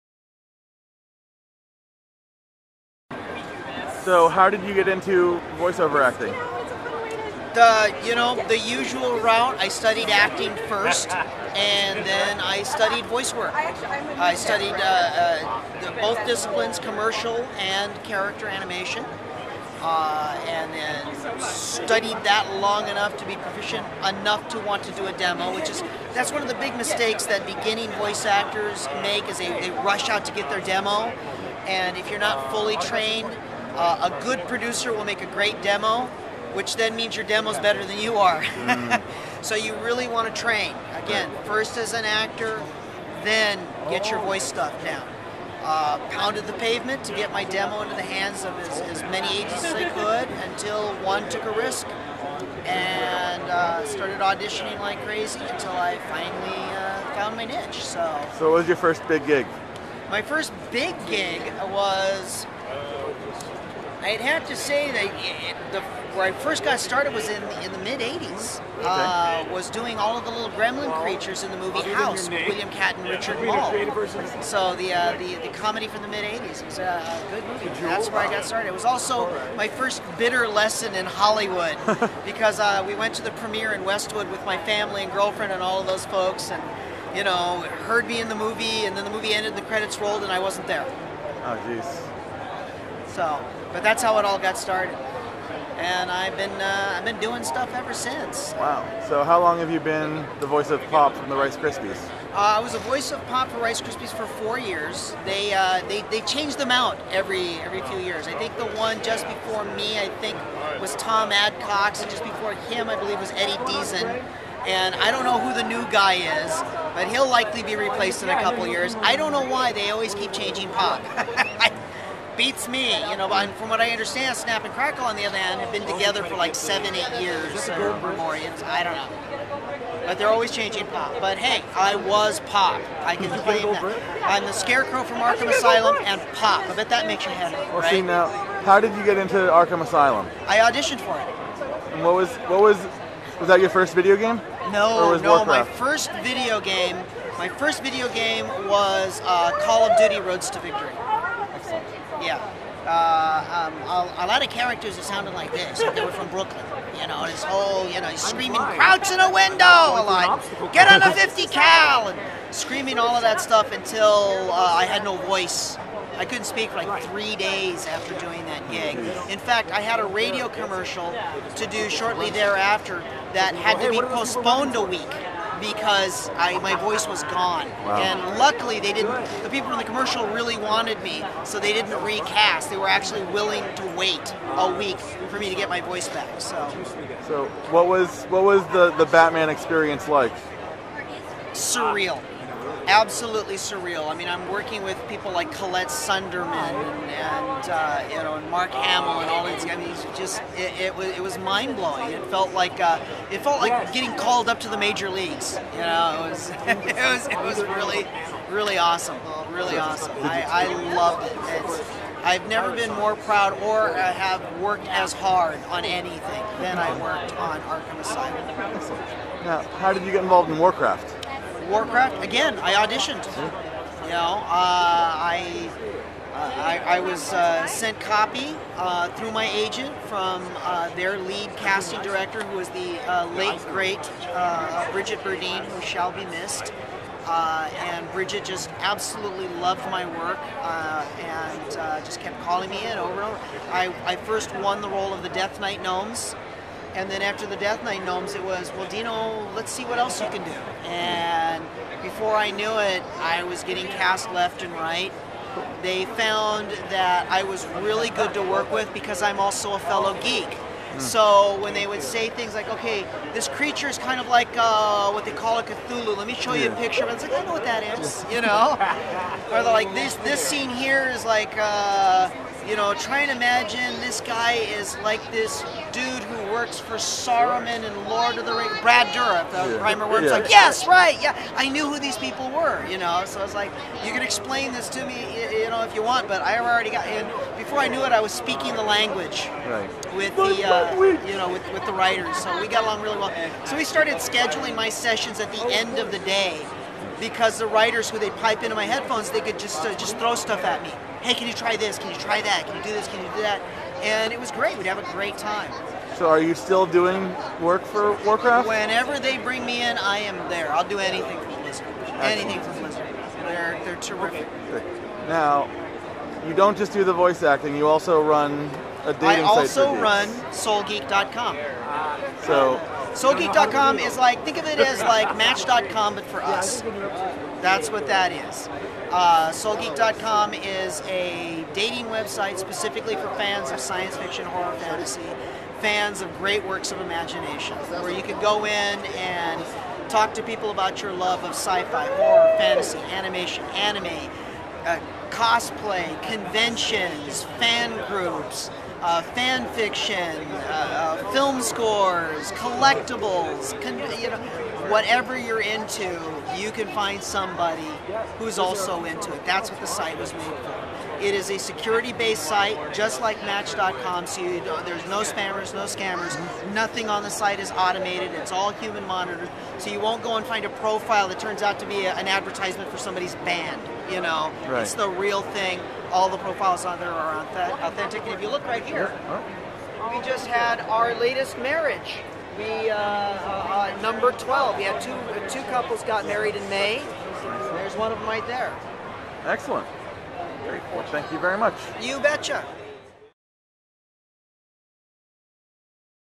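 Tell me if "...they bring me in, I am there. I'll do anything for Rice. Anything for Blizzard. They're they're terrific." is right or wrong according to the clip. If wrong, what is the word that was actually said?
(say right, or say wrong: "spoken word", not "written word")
wrong: "Blizzard", not "Rice".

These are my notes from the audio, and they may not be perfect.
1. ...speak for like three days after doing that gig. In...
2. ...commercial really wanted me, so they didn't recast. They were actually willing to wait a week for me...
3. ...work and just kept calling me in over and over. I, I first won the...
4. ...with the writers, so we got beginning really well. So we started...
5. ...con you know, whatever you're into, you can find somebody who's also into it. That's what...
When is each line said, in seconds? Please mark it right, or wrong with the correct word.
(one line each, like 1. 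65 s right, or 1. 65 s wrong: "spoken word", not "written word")
1. 166 s right
2. 179 s right
3. 240 s right
4. 291 s wrong: "along", not "beginning"
5. 353 s right.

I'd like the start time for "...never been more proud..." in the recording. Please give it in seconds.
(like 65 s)
212 s.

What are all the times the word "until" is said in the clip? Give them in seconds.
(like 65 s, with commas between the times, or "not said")
50 s, 55 s, 163 s.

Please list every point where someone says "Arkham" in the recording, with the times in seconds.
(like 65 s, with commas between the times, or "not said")
135 s, 139 s, 217 s.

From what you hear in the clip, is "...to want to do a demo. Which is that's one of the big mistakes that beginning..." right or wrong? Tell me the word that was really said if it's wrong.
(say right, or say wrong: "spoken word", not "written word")
right.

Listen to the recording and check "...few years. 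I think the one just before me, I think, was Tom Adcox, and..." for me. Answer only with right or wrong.
right.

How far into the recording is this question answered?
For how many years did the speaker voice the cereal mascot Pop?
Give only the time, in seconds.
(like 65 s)
104 s.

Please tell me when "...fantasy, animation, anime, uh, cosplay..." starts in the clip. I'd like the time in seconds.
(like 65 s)
342 s.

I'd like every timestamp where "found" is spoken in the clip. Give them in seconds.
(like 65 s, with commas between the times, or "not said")
57 s, 256 s.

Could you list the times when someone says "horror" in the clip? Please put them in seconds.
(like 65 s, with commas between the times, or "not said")
334 s, 342 s.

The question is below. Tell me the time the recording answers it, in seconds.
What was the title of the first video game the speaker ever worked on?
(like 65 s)
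149 s.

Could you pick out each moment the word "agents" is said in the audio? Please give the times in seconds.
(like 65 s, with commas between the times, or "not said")
49 s, 229 s.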